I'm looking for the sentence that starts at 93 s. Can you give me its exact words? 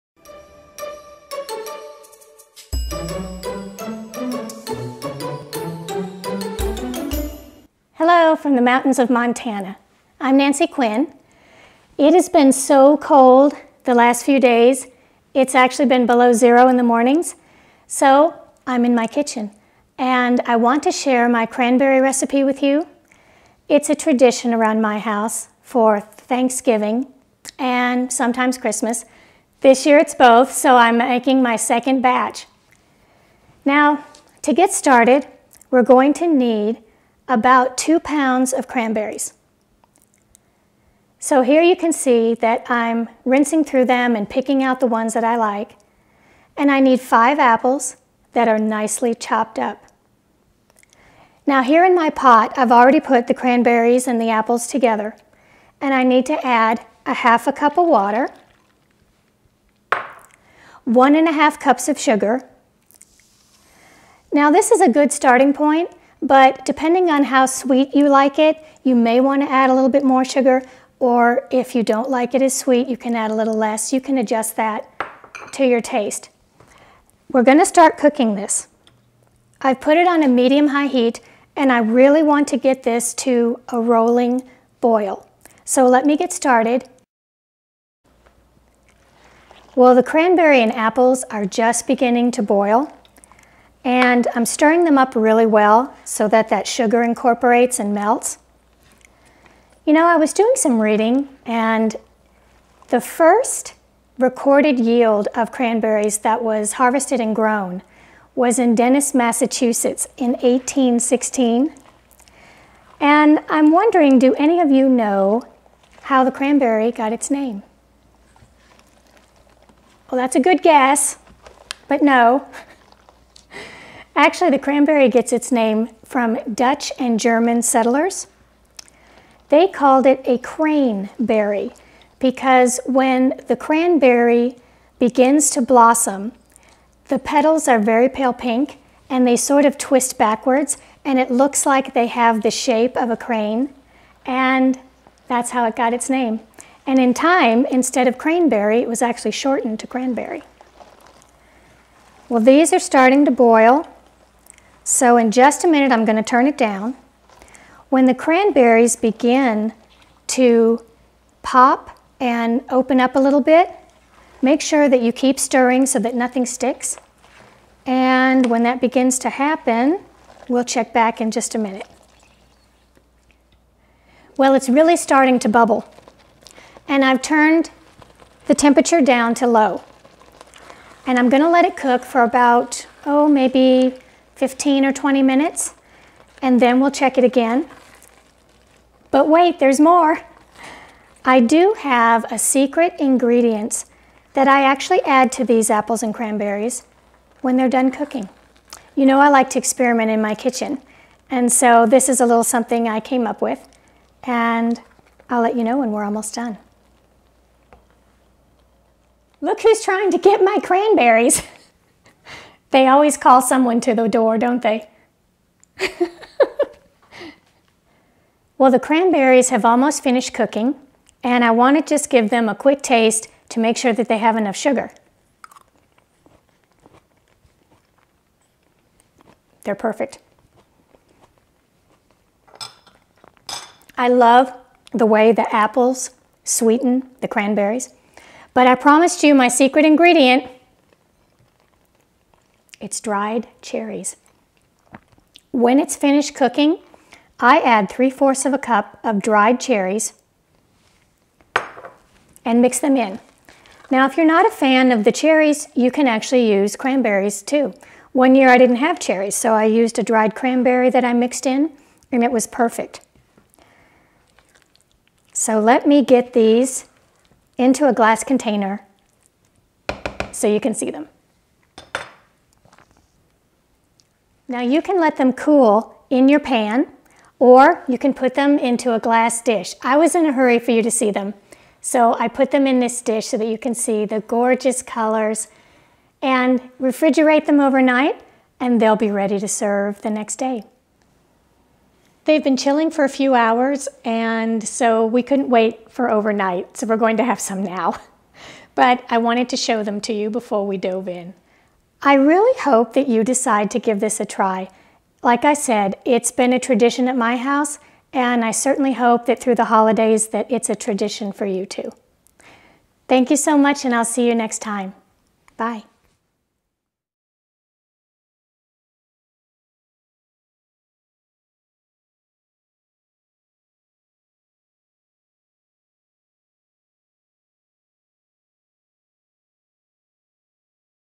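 And I'm stirring them up really well so that that sugar incorporates and melts.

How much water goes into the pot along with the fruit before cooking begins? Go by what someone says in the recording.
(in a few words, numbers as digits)
1/2 cup.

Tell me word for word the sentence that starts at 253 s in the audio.
Now, if you're not a fan of the cherries, you can actually use cranberries too.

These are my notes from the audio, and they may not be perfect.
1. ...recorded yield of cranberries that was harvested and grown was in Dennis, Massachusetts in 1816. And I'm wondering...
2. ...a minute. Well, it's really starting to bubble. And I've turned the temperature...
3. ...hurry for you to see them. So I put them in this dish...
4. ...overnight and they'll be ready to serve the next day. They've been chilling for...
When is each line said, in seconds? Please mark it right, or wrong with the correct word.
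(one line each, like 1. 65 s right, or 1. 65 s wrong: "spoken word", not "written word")
1. 104 s right
2. 171 s right
3. 280 s right
4. 287 s right.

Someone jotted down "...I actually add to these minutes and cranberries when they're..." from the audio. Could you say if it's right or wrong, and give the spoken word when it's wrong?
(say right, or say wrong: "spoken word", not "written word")
wrong: "apples", not "minutes".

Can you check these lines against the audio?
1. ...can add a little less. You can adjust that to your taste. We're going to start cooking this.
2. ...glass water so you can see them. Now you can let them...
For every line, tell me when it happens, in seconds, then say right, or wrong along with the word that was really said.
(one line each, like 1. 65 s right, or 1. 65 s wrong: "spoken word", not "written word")
1. 72 s right
2. 267 s wrong: "container", not "water".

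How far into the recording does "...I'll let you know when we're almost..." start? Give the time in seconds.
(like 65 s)
205 s.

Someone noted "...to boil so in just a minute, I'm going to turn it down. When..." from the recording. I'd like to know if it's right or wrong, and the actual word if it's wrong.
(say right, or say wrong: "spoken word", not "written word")
right.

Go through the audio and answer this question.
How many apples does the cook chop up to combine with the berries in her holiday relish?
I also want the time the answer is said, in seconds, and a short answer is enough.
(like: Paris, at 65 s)
5, at 46 s.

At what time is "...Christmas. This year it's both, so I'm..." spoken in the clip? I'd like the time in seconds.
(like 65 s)
28 s.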